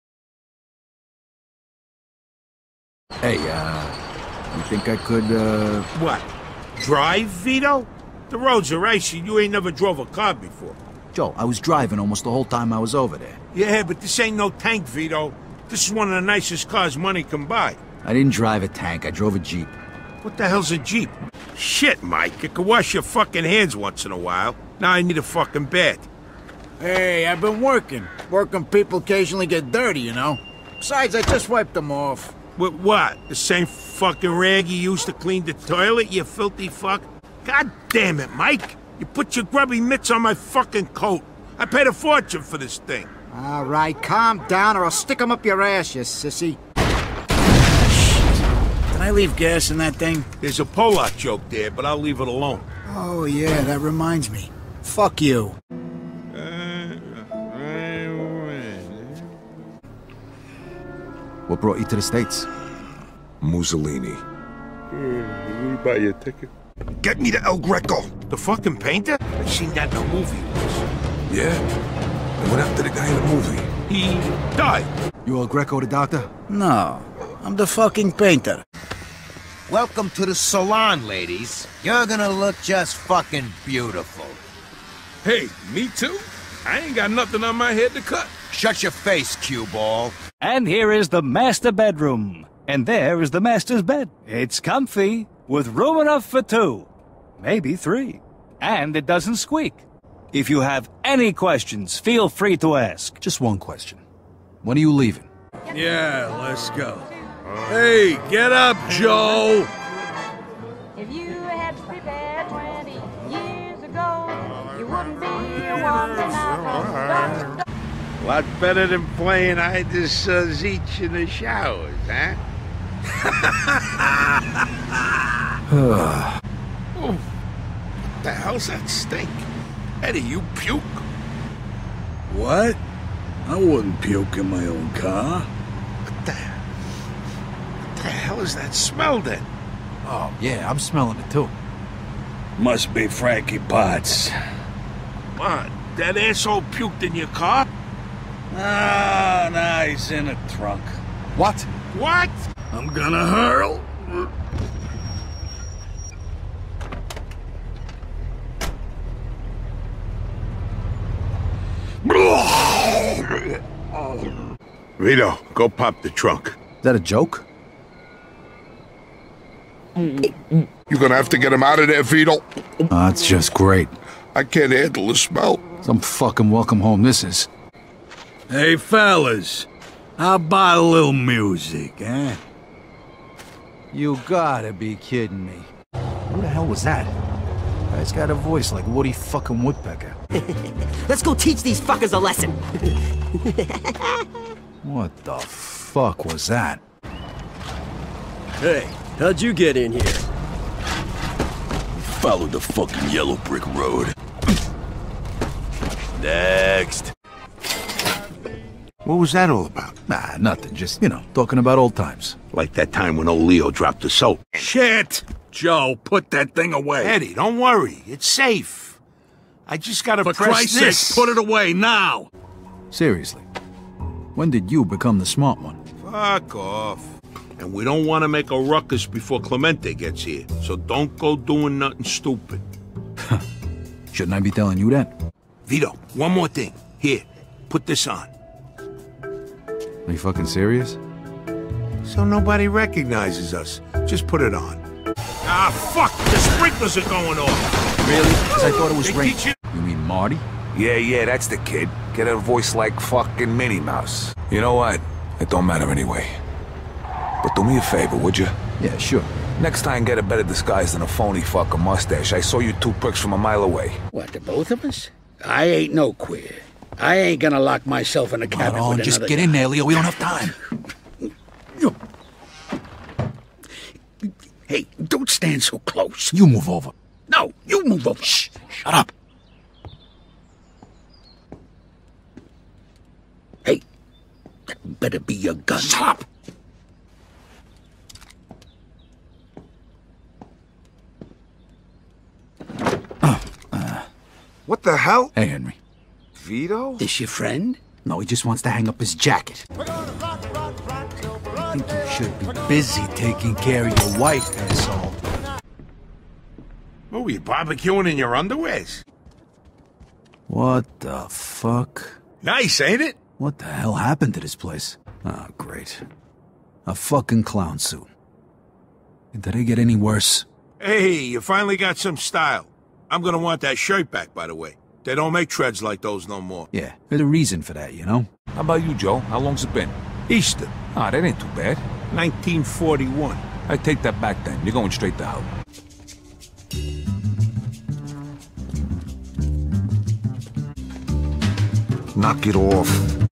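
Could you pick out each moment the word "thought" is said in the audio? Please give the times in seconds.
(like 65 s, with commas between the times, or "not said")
248 s.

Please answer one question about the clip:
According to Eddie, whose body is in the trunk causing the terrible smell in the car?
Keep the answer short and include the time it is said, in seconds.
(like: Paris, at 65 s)
Frankie Potts, at 143 s.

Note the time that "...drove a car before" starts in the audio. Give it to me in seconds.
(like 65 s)
9 s.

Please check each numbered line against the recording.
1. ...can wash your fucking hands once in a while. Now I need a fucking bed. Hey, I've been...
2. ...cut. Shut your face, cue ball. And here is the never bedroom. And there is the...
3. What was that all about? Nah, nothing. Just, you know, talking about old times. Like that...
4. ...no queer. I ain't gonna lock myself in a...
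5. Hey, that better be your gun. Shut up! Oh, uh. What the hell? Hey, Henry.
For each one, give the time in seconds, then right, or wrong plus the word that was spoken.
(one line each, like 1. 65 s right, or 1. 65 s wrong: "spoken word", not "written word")
1. 22 s right
2. 88 s wrong: "master", not "never"
3. 209 s right
4. 265 s right
5. 283 s right.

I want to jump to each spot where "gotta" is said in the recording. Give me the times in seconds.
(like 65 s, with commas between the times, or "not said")
184 s, 220 s.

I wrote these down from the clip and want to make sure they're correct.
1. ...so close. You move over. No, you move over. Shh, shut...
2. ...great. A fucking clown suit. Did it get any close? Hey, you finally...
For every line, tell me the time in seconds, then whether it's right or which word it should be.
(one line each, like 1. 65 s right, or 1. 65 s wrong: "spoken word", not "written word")
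1. 275 s right
2. 315 s wrong: "worse", not "close".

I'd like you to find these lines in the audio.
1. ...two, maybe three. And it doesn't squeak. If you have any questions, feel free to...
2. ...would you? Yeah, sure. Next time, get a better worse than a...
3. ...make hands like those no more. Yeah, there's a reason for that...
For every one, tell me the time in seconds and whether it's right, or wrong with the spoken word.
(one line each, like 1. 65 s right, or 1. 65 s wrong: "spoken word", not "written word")
1. 96 s right
2. 258 s wrong: "disguise", not "worse"
3. 325 s wrong: "treads", not "hands".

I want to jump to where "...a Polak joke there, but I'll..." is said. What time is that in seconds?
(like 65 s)
50 s.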